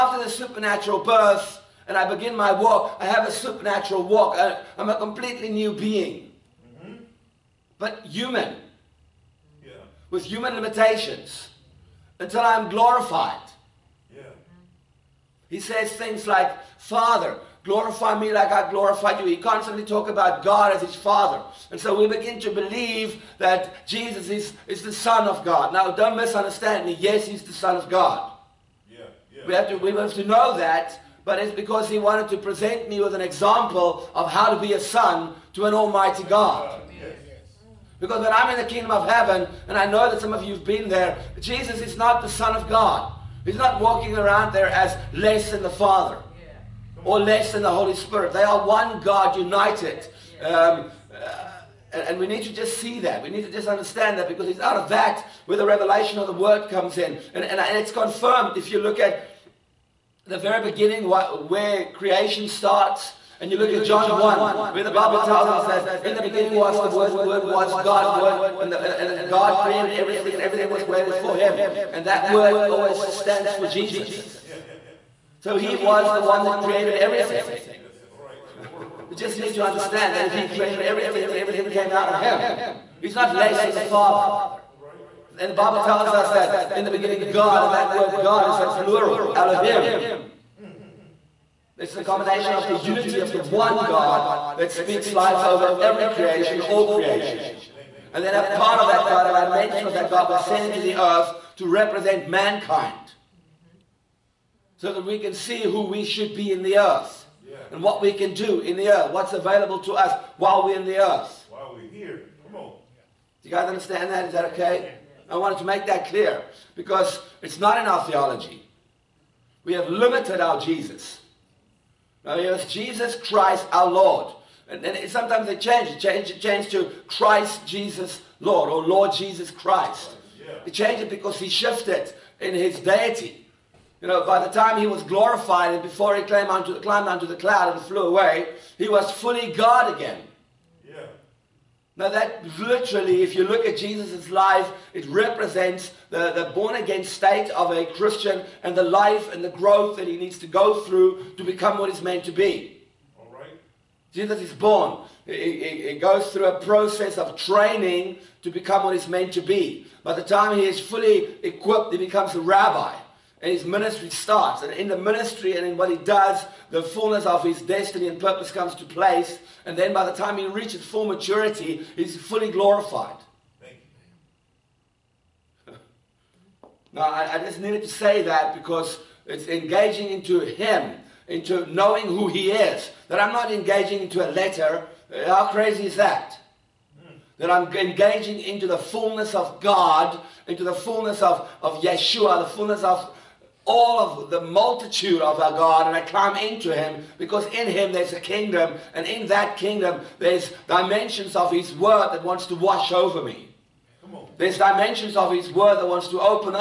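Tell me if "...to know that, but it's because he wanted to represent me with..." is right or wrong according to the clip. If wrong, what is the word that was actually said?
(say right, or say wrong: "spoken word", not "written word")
wrong: "present", not "represent".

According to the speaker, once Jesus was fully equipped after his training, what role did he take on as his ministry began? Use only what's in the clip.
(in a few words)
Rabbi.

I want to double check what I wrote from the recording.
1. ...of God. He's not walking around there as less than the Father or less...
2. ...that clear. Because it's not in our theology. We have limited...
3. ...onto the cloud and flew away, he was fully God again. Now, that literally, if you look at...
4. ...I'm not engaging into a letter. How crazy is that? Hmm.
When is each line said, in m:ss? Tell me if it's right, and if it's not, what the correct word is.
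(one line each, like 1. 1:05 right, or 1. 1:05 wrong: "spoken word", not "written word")
1. 0:42 right
2. 1:55 right
3. 2:17 right
4. 3:03 right.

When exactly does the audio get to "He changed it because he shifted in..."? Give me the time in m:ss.
2:10.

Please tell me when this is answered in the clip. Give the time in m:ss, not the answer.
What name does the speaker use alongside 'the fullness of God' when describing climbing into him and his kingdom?
3:11.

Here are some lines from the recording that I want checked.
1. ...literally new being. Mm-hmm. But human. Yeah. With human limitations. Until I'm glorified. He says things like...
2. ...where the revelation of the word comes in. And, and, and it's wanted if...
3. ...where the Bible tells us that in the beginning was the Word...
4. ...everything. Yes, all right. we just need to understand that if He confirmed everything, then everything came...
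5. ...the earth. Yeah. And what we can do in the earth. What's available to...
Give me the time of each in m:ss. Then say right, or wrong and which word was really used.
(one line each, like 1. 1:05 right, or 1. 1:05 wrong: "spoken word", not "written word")
1. 0:04 wrong: "completely", not "literally"
2. 0:55 wrong: "confirmed", not "wanted"
3. 1:04 right
4. 1:16 wrong: "created", not "confirmed"
5. 1:46 right.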